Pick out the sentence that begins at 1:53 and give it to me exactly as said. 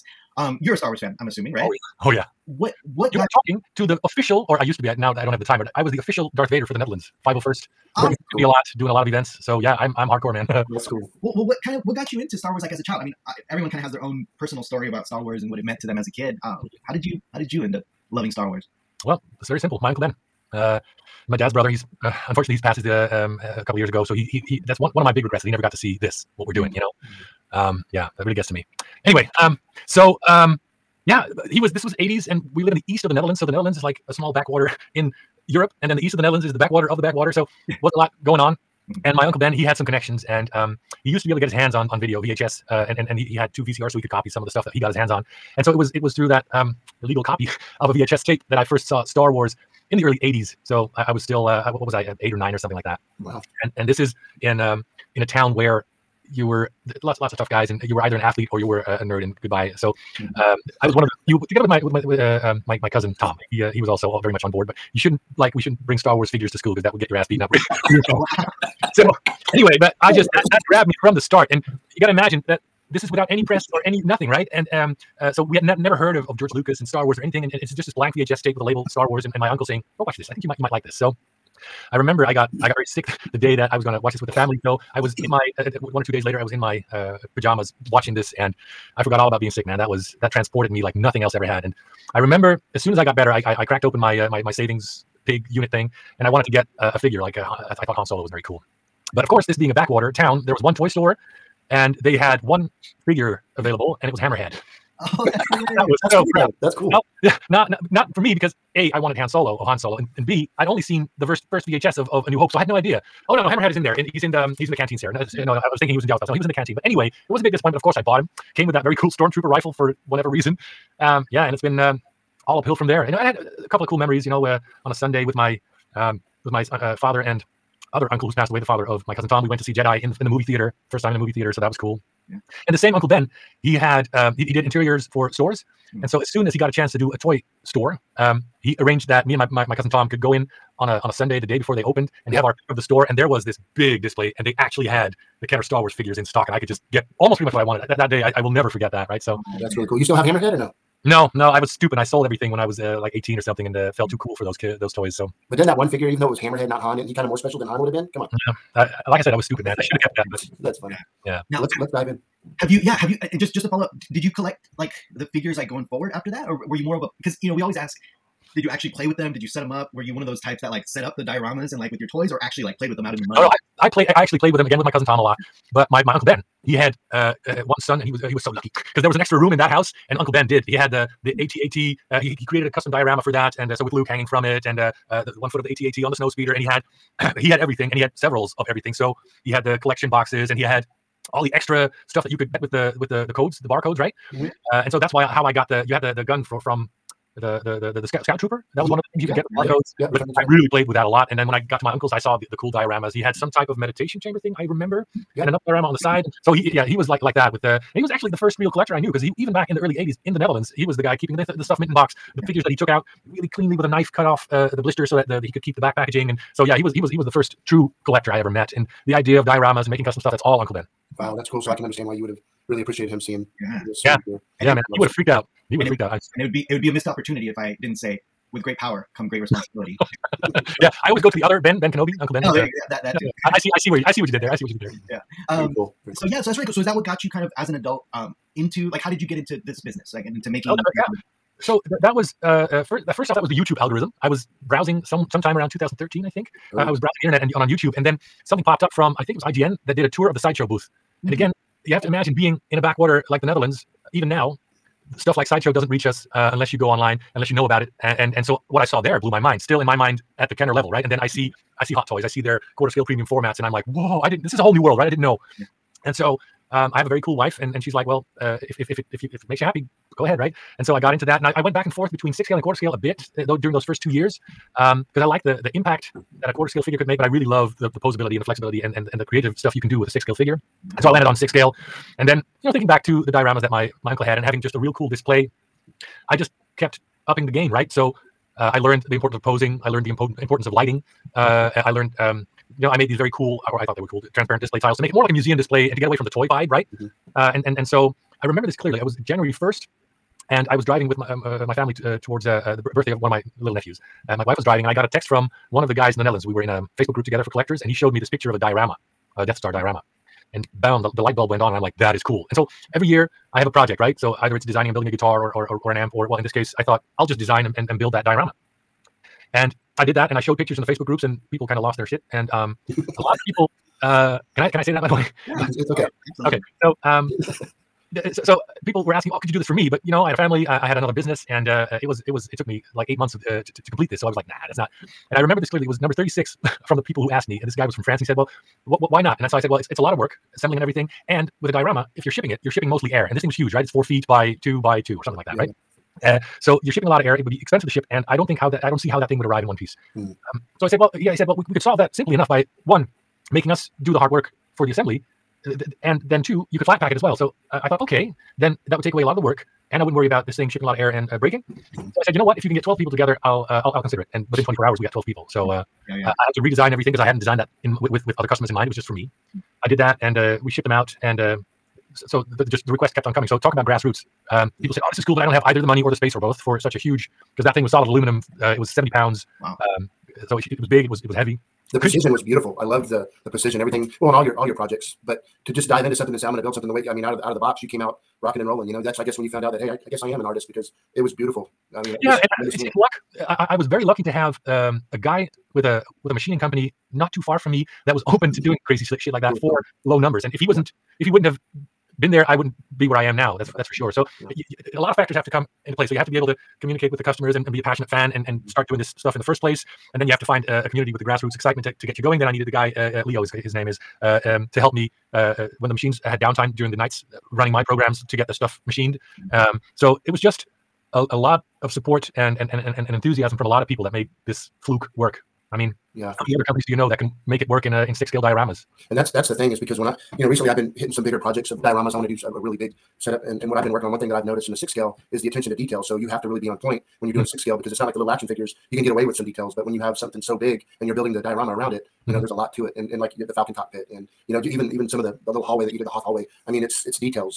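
Oh no, no, Hammerhead is in there, and he's in the um, he's in the canteen, Sarah.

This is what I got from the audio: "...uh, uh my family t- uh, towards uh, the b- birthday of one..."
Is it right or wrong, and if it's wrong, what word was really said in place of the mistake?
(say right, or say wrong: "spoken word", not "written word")
right.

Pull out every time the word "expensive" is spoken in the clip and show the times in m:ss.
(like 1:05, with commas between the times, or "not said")
5:47.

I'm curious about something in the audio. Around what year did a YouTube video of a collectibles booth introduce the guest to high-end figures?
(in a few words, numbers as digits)
2013.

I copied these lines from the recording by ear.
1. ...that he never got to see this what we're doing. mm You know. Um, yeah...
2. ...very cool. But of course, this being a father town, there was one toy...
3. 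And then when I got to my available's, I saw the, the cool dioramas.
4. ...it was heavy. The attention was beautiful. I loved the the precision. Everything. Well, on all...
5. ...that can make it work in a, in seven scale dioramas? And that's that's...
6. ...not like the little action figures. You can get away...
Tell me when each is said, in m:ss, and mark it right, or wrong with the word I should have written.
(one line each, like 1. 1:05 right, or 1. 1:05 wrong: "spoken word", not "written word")
1. 0:25 right
2. 1:38 wrong: "backwater", not "father"
3. 3:21 wrong: "uncle", not "available"
4. 6:21 wrong: "precision", not "attention"
5. 7:07 wrong: "six", not "seven"
6. 7:17 right.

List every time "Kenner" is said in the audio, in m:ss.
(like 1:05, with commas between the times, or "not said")
2:25, 4:20.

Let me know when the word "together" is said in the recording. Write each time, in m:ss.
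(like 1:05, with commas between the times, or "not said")
1:01, 5:07, 6:03.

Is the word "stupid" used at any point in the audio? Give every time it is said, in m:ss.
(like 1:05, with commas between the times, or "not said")
2:31, 2:39.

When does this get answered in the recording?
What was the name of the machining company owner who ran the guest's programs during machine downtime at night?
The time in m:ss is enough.
6:53.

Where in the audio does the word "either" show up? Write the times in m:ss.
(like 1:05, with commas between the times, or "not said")
0:58, 5:14, 6:15.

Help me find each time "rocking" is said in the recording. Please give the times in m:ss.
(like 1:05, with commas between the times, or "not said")
6:28.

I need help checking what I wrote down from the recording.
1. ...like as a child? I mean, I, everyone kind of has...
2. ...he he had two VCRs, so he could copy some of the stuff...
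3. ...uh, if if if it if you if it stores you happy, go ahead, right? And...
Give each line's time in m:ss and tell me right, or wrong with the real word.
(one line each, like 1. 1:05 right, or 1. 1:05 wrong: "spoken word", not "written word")
1. 0:12 right
2. 0:43 right
3. 4:28 wrong: "makes", not "stores".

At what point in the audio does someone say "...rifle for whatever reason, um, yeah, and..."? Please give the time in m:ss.
1:59.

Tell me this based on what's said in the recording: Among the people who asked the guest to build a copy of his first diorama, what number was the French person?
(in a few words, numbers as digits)
36.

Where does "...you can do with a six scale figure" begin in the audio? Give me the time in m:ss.
4:39.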